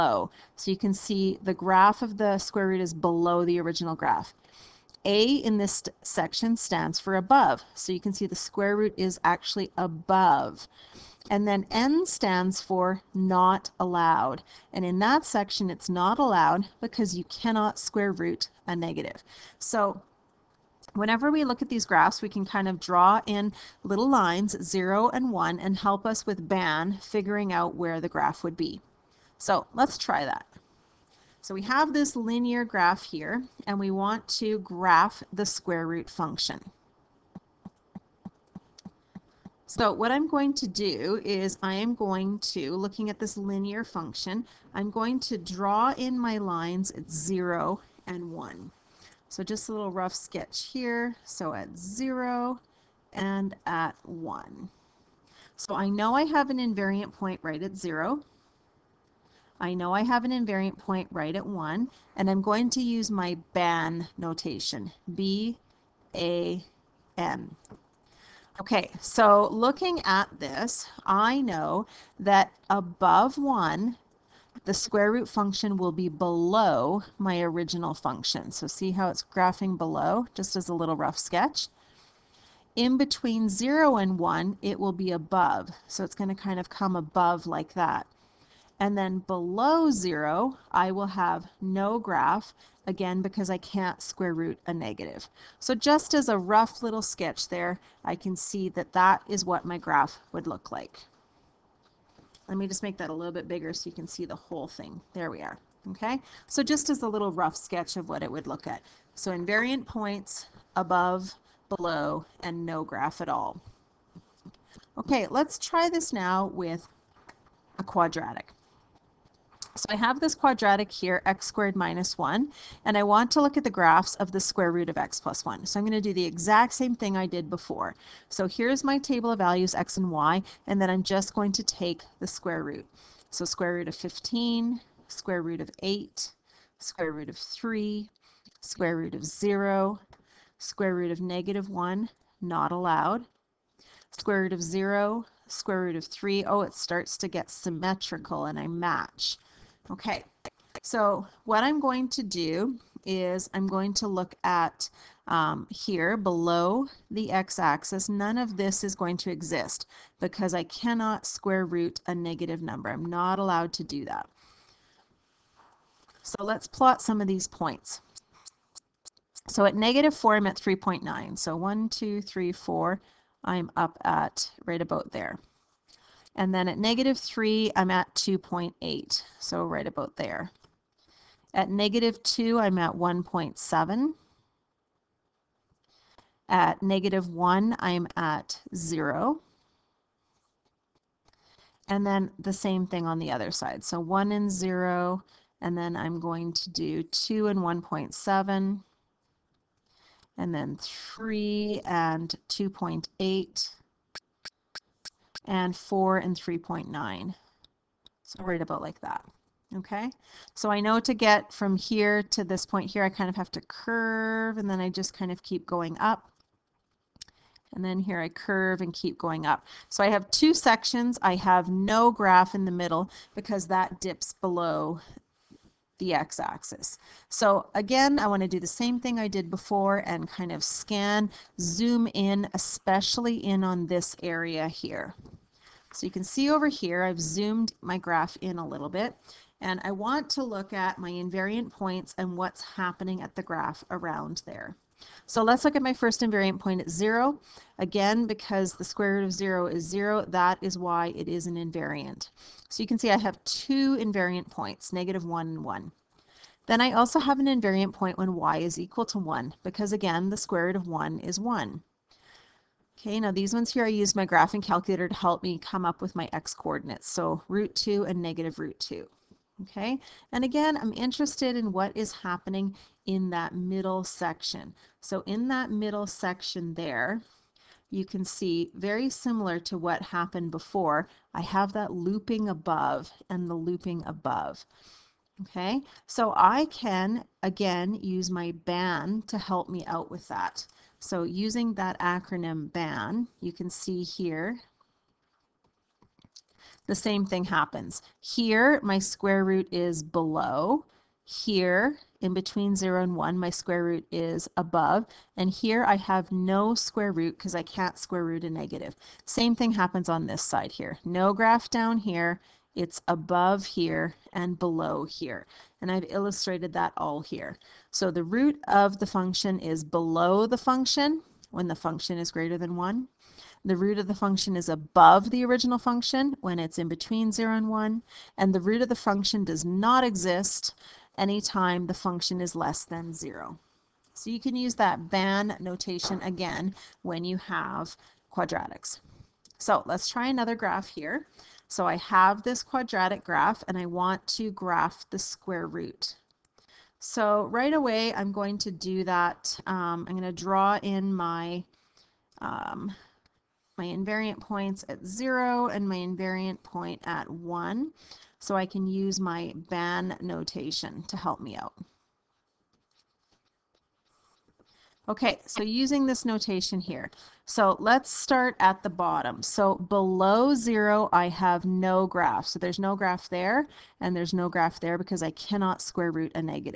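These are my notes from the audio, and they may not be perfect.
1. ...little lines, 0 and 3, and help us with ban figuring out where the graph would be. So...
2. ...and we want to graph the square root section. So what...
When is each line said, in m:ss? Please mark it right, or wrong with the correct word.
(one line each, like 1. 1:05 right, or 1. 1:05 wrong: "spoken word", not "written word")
1. 0:23 wrong: "1", not "3"
2. 0:33 wrong: "function", not "section".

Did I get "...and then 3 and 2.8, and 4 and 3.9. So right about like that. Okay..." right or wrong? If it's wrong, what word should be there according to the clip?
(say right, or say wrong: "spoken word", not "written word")
right.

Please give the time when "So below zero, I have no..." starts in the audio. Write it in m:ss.
6:09.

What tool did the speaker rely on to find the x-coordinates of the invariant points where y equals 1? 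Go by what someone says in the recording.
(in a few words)
graphing calculator.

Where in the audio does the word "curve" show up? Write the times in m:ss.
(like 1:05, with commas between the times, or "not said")
3:33, 3:38.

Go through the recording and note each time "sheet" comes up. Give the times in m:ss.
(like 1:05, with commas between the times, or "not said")
not said.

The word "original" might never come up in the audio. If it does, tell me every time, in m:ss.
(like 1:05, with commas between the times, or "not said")
0:03, 1:17, 5:25.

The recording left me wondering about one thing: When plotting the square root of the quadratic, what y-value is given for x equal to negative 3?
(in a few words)
2.8.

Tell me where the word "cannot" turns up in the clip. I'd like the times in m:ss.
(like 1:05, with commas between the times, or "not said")
0:17, 2:40, 6:15.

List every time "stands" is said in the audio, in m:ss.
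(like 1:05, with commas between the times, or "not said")
0:06, 0:12.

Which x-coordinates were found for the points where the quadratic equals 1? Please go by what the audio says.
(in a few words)
root 2 and negative root 2.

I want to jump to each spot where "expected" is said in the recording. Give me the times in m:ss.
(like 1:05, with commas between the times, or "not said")
not said.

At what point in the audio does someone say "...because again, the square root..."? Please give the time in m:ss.
4:19.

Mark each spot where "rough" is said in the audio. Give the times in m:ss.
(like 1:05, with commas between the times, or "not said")
0:49, 1:20, 1:36, 1:47.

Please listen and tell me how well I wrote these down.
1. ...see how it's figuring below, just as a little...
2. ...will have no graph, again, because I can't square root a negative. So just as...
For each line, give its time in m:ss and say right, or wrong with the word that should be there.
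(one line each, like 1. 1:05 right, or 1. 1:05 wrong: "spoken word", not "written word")
1. 1:18 wrong: "graphing", not "figuring"
2. 1:30 right.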